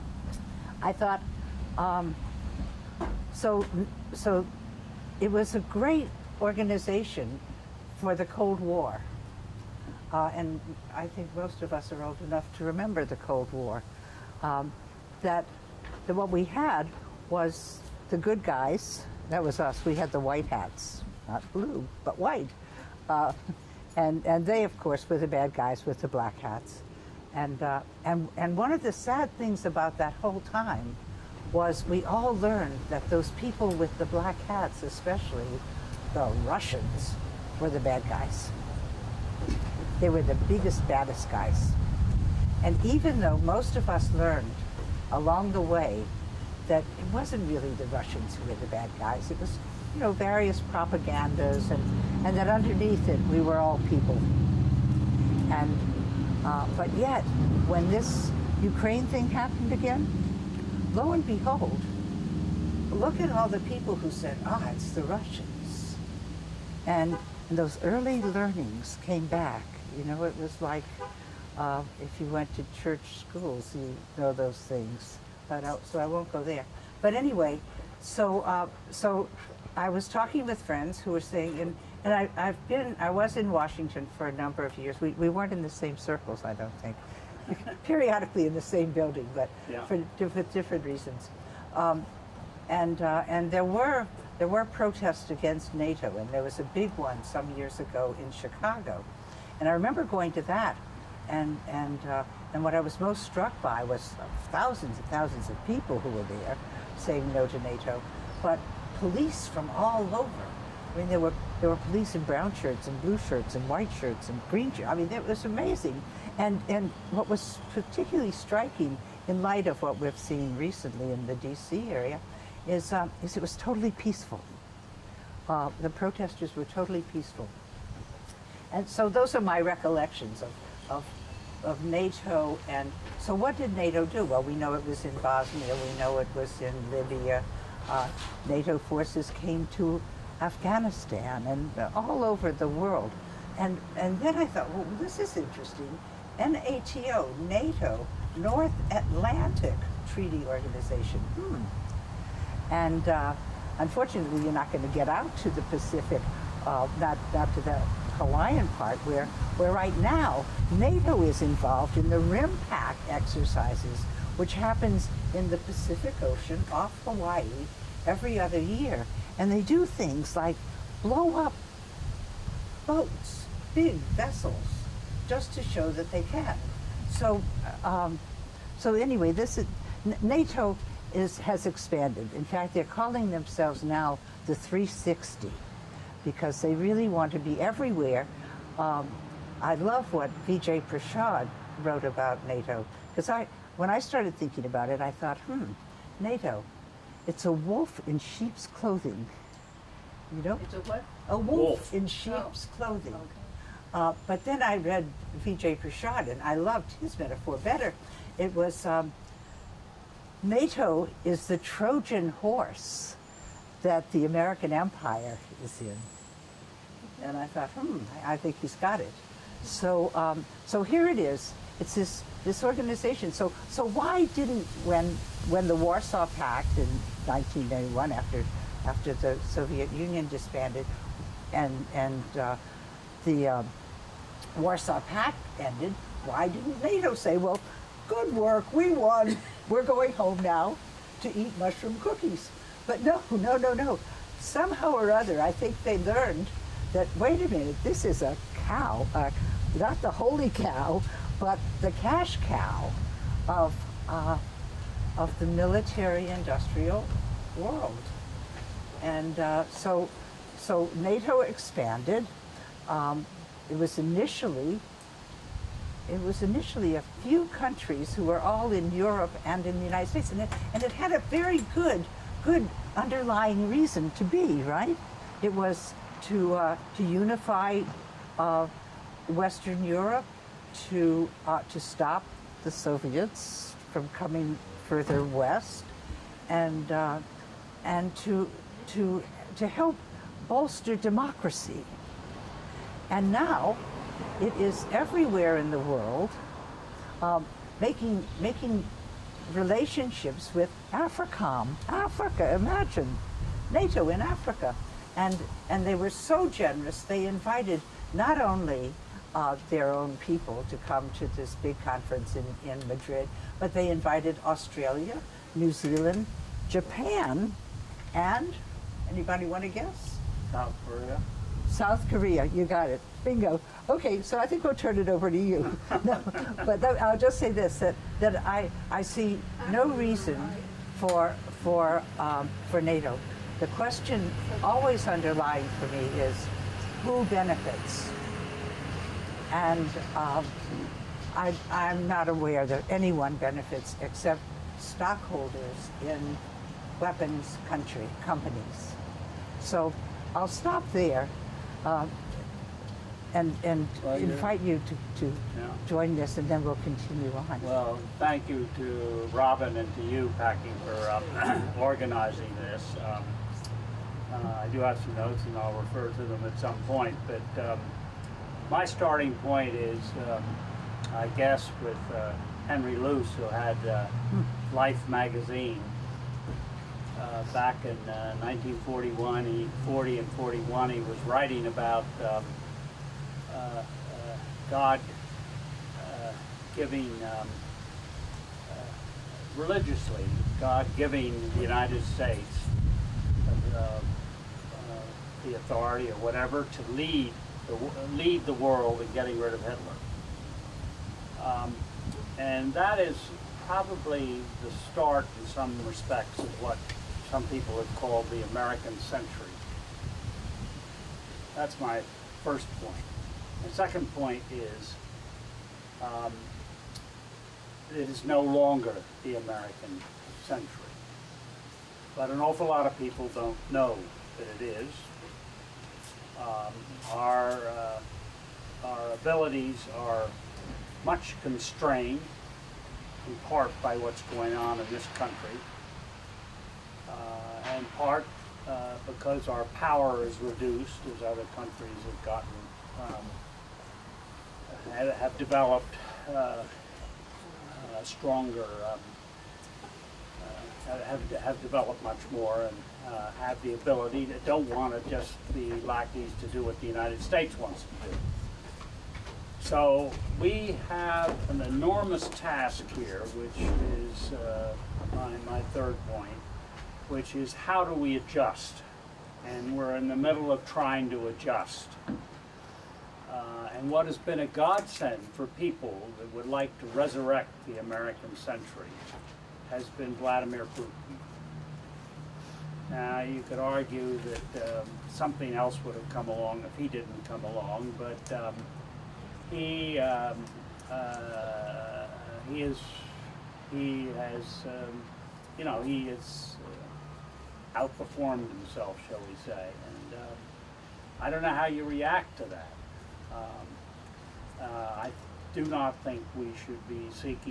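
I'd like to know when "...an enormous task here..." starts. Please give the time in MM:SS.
07:41.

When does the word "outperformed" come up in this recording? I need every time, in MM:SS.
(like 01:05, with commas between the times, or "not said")
08:17.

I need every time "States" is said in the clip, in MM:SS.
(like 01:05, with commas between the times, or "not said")
04:30, 06:32, 07:37.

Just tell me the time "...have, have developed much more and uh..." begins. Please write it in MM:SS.
07:31.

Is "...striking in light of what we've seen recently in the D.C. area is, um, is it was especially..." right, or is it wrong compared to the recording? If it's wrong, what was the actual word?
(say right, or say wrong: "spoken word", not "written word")
wrong: "totally", not "especially".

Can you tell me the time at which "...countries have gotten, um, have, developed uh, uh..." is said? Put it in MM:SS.
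07:21.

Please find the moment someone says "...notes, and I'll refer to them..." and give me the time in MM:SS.
06:05.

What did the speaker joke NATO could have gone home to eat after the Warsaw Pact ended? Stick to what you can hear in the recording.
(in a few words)
mushroom cookies.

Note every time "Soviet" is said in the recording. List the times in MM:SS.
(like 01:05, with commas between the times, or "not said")
03:49, 04:42.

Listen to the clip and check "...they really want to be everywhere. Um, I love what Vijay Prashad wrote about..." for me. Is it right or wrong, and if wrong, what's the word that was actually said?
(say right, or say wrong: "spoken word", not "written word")
right.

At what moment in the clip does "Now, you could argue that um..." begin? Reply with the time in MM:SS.
08:02.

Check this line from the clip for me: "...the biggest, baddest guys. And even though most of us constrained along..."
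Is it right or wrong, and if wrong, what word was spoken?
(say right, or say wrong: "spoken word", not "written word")
wrong: "learned", not "constrained".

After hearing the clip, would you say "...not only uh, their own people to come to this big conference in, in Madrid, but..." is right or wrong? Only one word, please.
right.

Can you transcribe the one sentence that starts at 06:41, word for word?
Um, and that is probably the start in some respects of what some people have called the American century.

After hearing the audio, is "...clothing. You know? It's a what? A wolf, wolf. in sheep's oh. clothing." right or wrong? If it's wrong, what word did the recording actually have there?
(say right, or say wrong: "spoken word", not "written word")
right.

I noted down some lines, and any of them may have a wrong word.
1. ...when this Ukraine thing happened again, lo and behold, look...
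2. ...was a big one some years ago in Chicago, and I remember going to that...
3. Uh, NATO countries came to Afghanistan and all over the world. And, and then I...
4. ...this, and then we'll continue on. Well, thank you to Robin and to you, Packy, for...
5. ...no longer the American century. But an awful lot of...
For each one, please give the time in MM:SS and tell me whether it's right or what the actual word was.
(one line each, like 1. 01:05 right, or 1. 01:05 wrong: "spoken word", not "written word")
1. 00:57 right
2. 01:36 right
3. 02:17 wrong: "forces", not "countries"
4. 05:56 right
5. 06:58 right.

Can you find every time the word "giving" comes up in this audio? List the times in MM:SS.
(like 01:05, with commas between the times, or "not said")
06:26, 06:30.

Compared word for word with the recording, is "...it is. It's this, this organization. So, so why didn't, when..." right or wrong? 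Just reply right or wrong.
right.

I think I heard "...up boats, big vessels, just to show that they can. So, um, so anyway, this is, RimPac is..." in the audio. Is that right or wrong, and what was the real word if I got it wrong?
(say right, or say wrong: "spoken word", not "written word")
wrong: "NATO", not "RimPac".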